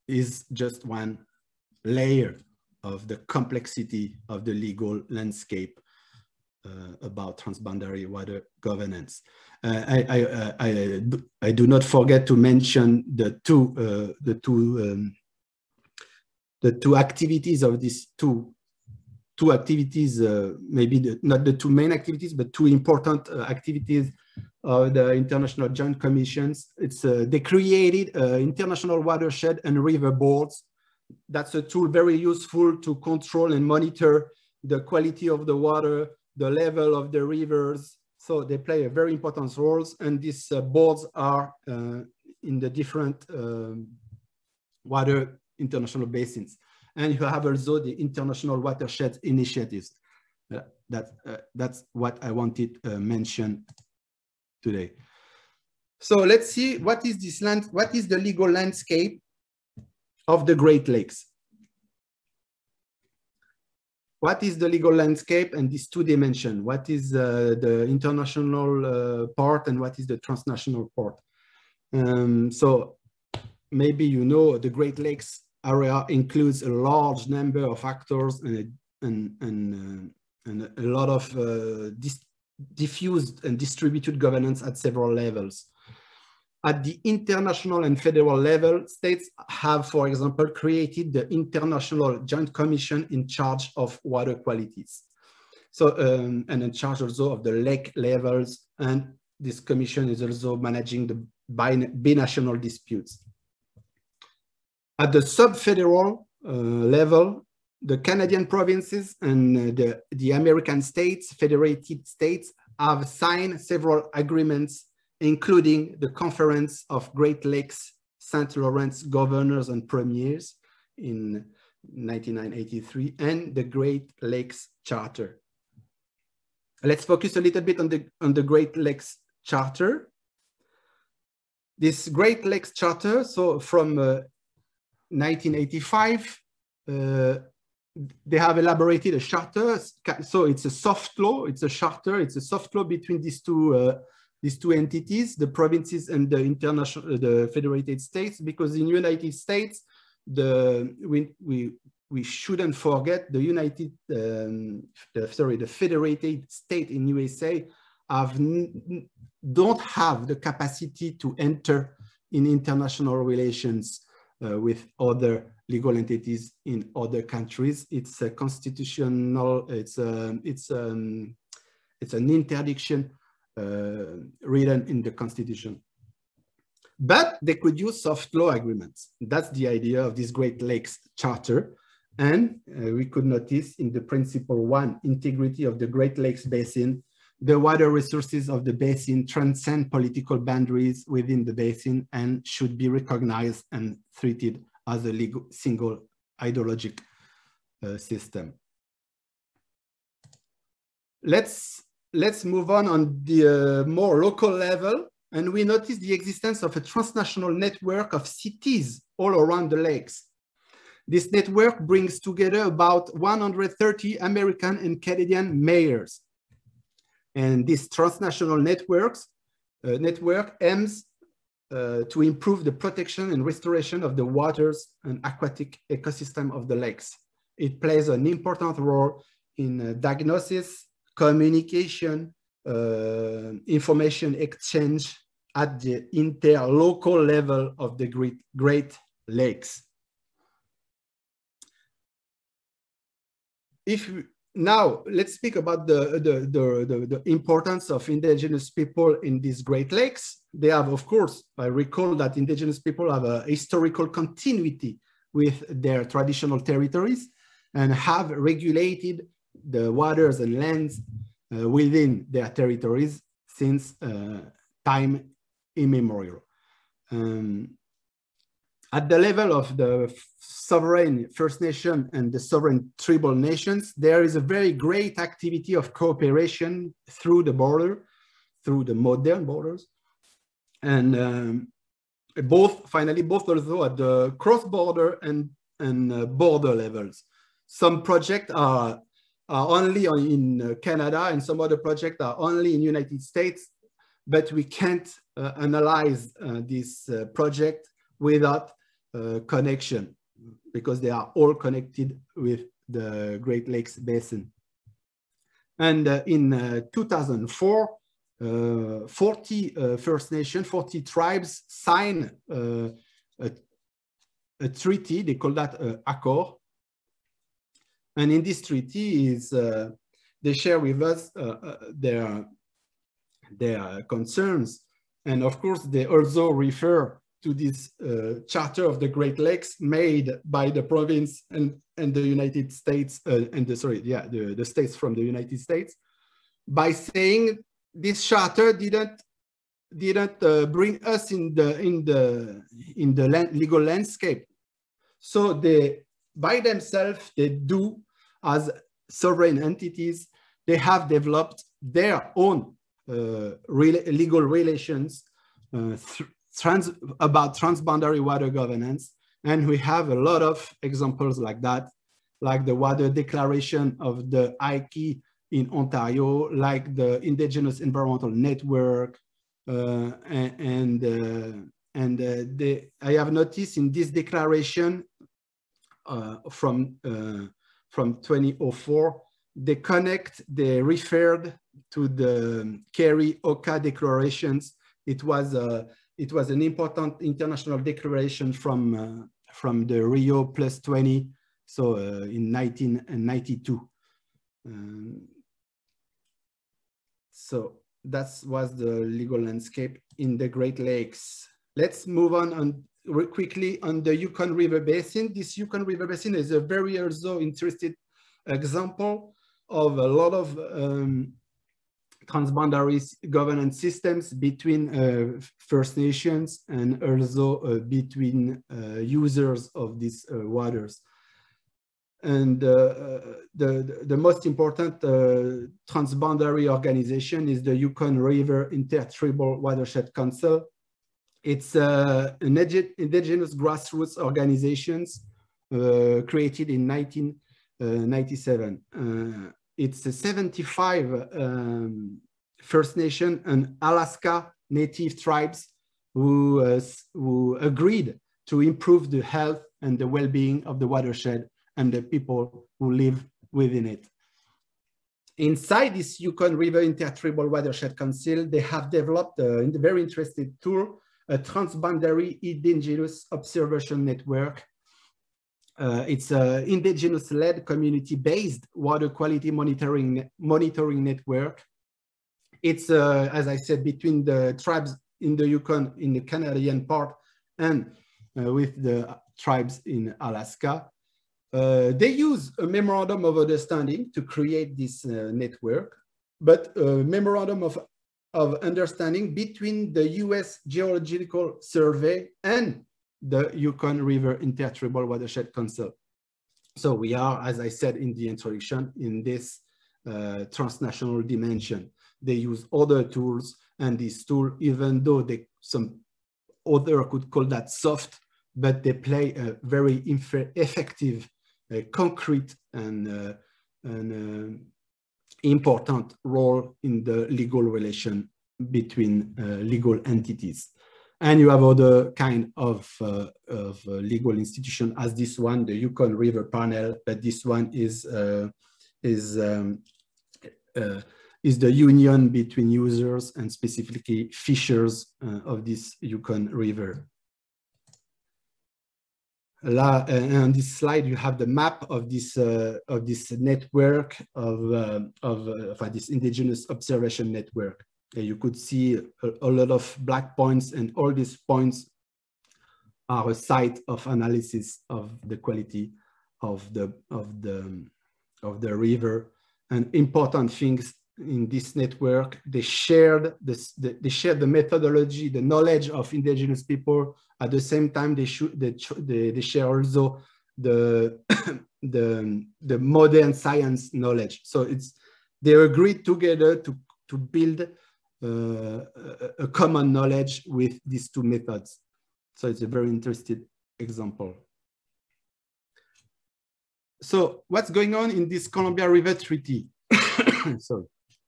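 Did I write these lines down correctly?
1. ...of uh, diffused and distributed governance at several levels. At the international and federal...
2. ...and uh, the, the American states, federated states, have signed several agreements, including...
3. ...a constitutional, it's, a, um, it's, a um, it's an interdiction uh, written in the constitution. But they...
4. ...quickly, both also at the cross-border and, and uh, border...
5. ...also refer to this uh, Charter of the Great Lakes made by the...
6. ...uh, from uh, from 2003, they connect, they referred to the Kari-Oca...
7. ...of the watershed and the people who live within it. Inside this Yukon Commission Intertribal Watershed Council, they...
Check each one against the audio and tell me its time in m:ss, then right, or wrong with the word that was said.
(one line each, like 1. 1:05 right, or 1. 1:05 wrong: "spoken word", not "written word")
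1. 1:21 right
2. 1:49 right
3. 2:48 right
4. 4:42 wrong: "finally", not "quickly"
5. 5:26 right
6. 6:16 wrong: "2004", not "2003"
7. 7:30 wrong: "River", not "Commission".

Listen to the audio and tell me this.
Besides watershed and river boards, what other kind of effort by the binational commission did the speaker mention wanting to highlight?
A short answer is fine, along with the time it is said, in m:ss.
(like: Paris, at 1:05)
International watershed initiatives, at 0:47.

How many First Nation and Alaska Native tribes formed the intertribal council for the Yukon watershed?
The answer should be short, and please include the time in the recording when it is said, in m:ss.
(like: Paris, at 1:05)
75, at 7:20.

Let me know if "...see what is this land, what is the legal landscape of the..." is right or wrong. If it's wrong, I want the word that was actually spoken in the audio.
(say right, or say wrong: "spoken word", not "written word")
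right.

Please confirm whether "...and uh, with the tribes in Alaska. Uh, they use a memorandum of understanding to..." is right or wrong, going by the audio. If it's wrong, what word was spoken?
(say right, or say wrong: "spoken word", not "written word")
right.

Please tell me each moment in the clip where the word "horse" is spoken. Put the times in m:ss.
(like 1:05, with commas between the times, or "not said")
not said.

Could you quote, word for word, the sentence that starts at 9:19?
And important things in this network.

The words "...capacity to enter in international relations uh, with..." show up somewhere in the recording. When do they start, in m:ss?
2:40.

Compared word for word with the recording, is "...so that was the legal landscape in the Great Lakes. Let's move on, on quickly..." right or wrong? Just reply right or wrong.
right.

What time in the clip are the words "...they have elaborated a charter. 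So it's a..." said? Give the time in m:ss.
2:18.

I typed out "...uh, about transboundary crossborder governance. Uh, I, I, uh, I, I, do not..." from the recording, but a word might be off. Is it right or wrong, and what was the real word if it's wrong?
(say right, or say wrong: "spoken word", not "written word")
wrong: "water", not "crossborder".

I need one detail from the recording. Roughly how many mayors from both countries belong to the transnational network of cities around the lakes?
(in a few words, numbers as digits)
130.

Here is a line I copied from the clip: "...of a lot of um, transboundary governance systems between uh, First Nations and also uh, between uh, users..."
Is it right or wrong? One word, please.
right.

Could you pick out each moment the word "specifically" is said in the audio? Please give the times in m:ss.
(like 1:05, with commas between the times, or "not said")
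8:53.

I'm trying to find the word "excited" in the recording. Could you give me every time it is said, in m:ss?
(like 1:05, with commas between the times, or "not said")
not said.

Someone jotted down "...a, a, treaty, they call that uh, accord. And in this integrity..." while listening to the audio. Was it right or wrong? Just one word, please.
wrong.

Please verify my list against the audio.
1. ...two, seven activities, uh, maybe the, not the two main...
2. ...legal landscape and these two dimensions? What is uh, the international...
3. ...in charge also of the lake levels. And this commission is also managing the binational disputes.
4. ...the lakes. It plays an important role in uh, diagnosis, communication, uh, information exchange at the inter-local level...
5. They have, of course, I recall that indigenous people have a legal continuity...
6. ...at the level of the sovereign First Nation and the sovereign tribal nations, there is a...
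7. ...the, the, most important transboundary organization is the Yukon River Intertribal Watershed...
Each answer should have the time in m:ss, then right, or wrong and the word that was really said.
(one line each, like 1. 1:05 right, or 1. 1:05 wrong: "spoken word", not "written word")
1. 0:18 wrong: "two", not "seven"
2. 1:04 right
3. 1:36 right
4. 3:46 right
5. 4:10 wrong: "historical", not "legal"
6. 4:28 right
7. 7:03 right.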